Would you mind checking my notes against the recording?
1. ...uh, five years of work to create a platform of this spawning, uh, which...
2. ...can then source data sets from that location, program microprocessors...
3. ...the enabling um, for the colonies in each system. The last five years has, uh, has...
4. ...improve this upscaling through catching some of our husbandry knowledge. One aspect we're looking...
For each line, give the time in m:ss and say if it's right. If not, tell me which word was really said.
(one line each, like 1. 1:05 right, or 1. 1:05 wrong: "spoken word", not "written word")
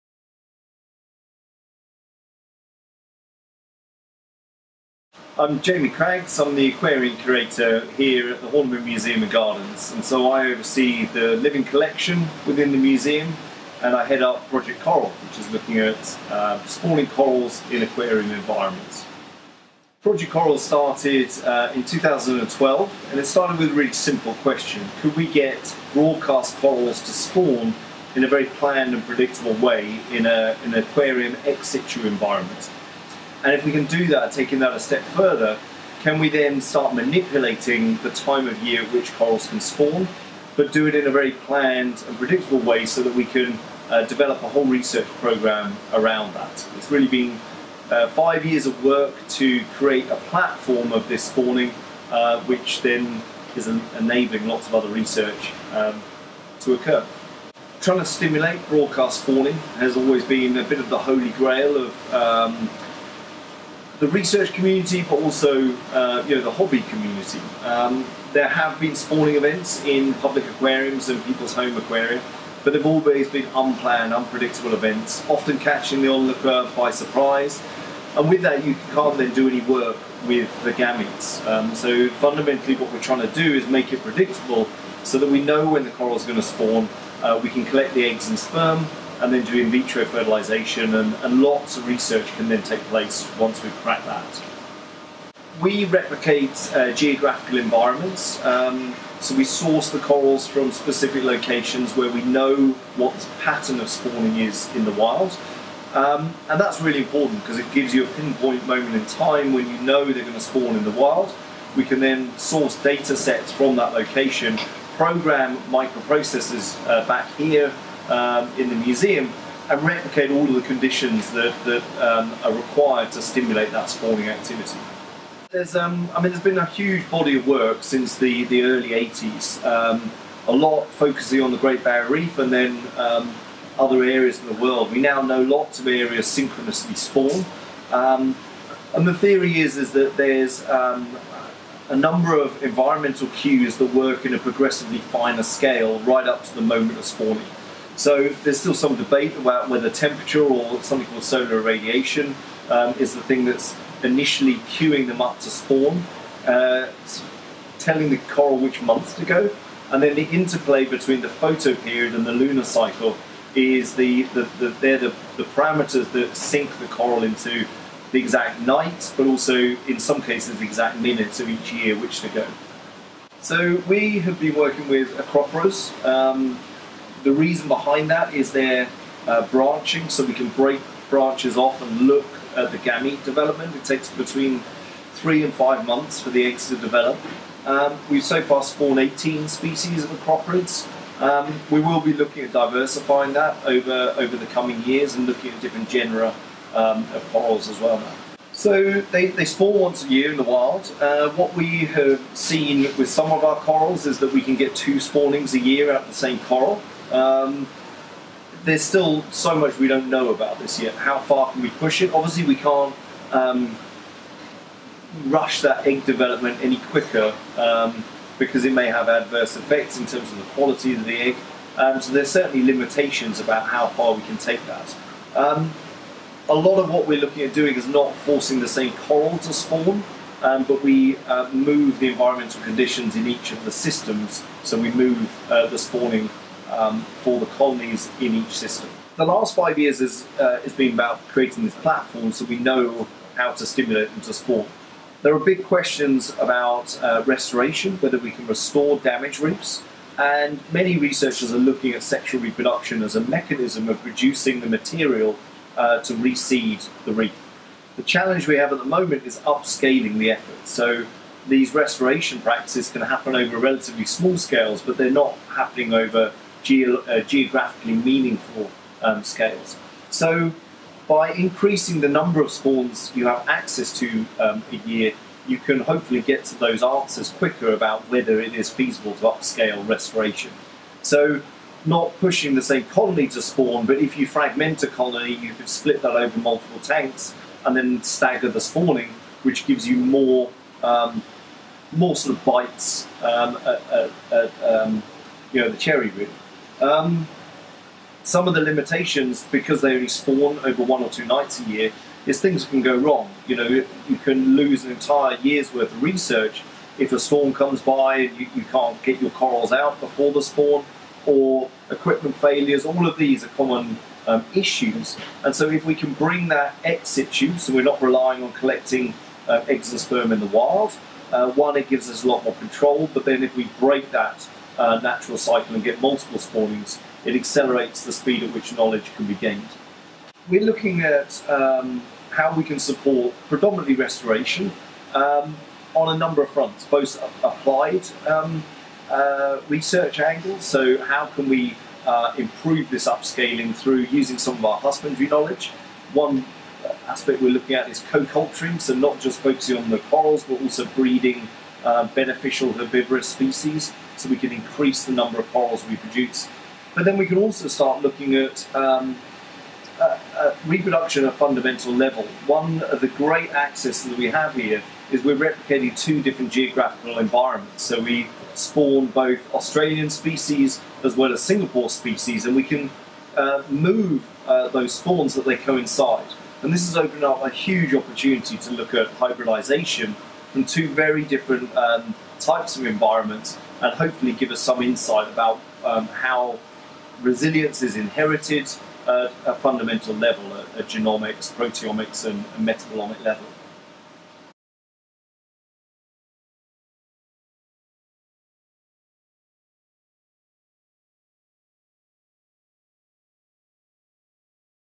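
1. 0:47 right
2. 1:51 right
3. 3:55 wrong: "spawning", not "enabling"
4. 5:42 wrong: "using", not "catching".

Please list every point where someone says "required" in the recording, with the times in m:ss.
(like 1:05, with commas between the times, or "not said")
2:02.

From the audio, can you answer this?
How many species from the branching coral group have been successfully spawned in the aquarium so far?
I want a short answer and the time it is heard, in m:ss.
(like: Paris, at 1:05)
18, at 3:08.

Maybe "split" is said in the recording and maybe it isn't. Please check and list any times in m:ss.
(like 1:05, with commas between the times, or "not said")
4:45.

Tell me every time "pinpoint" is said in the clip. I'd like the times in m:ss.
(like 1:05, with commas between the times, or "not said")
1:48.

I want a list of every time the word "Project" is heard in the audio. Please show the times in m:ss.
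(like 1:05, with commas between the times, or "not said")
0:14, 0:20.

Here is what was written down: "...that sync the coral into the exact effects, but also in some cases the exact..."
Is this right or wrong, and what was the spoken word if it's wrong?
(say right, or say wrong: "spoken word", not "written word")
wrong: "nights", not "effects".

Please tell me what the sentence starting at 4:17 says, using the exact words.
The challenge we have at the moment is upscaling the effort.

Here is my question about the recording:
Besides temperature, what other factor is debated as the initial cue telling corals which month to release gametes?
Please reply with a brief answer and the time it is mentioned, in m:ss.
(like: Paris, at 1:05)
solar irradiation, at 2:31.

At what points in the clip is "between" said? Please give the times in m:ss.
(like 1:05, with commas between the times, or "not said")
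2:40, 3:04.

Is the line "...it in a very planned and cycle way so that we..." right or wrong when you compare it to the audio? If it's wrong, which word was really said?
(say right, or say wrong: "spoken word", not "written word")
wrong: "predictable", not "cycle".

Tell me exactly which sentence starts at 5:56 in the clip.
But then we can also start looking at um, uh, uh, reproduction at a fundamental level.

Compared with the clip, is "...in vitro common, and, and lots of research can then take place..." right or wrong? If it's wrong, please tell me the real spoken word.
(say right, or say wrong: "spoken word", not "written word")
wrong: "fertilization", not "common".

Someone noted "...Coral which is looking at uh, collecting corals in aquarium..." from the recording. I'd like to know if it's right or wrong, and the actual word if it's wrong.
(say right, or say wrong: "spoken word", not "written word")
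wrong: "spawning", not "collecting".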